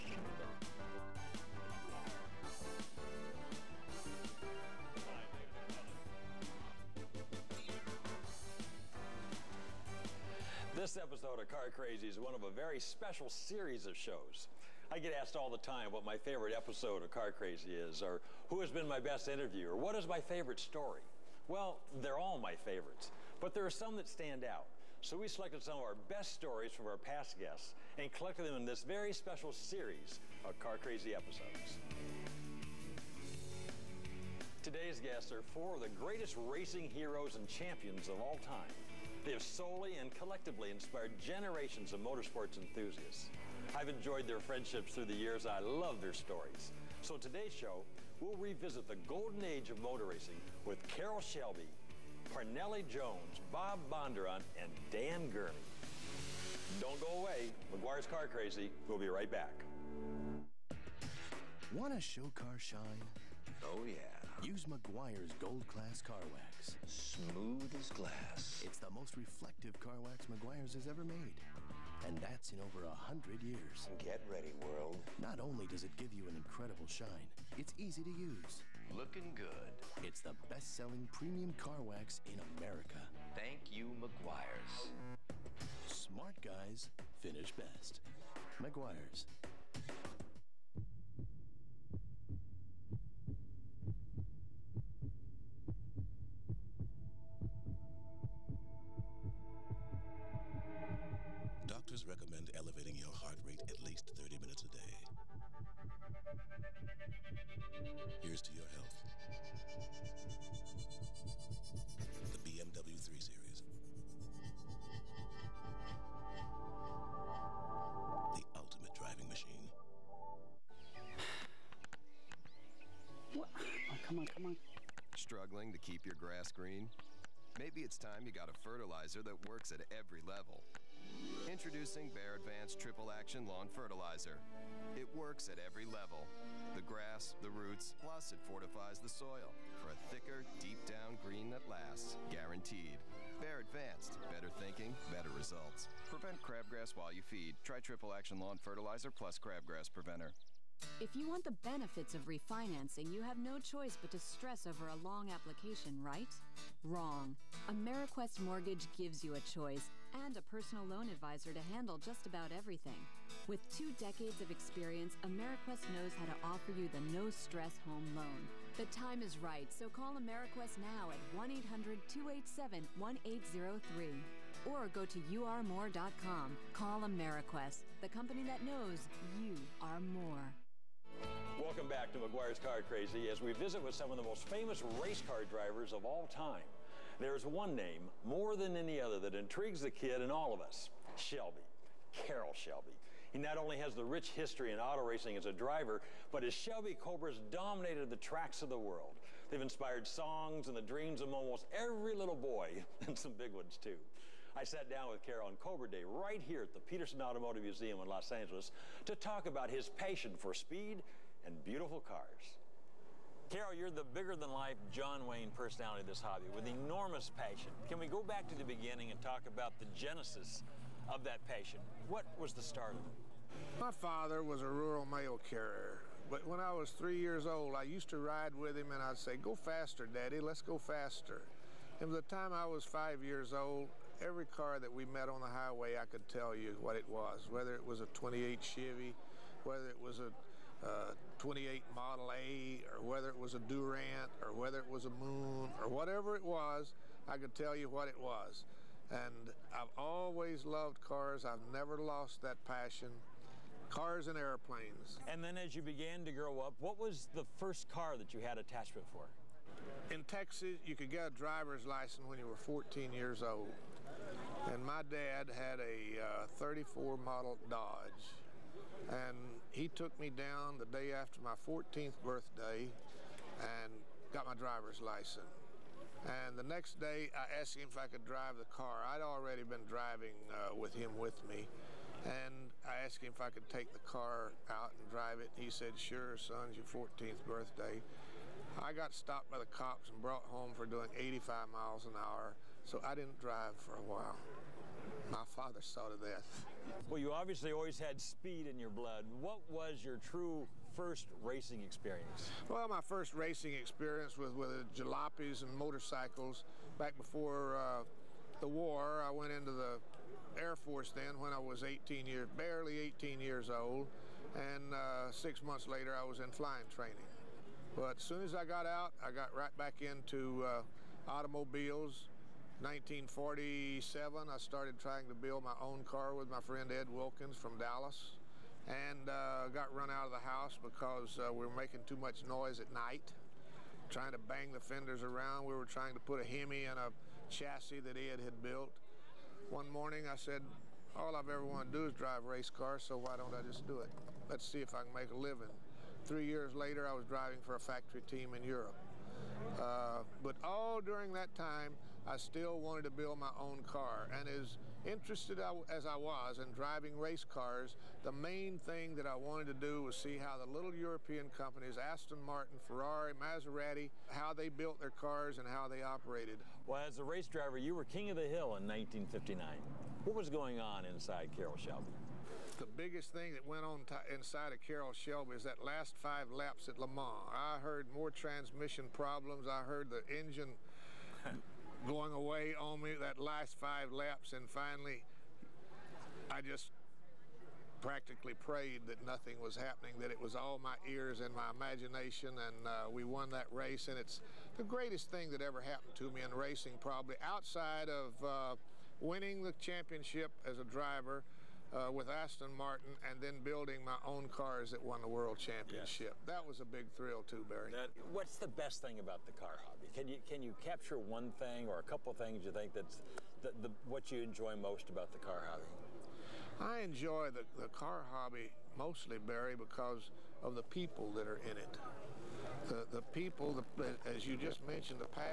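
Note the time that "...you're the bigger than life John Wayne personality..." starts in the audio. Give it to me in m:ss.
3:33.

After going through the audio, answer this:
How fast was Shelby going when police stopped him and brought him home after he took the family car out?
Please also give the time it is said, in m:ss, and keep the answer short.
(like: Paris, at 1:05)
85 mph, at 4:51.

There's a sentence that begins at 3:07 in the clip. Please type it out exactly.
There's one name, more than any other, that intrigues the kid and all of us Shelby.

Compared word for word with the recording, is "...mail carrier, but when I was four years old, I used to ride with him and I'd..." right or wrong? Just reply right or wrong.
wrong.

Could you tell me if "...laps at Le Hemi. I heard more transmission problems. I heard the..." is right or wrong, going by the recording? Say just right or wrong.
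wrong.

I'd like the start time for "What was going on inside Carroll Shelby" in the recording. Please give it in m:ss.
6:10.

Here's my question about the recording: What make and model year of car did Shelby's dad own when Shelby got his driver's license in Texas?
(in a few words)
1934 Dodge.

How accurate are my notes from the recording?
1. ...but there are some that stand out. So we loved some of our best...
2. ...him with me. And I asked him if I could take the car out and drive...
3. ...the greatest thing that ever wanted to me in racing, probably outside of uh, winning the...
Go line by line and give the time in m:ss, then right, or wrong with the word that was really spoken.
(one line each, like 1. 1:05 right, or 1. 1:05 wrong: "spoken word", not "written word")
1. 0:23 wrong: "selected", not "loved"
2. 4:40 right
3. 6:34 wrong: "happened", not "wanted".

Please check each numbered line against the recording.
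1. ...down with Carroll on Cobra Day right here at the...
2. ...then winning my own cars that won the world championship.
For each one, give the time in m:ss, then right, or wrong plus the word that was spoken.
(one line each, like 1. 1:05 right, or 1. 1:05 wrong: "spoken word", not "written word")
1. 3:24 right
2. 6:43 wrong: "building", not "winning".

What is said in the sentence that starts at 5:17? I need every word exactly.
But as soon as I got out, I got right back into uh, automobiles.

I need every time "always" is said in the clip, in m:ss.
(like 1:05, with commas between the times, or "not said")
4:09, 4:57.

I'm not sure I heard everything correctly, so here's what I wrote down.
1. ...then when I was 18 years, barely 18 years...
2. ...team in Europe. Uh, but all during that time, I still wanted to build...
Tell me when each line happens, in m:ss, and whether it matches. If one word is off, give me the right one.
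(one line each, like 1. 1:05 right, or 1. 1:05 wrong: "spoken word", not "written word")
1. 5:11 right
2. 5:48 right.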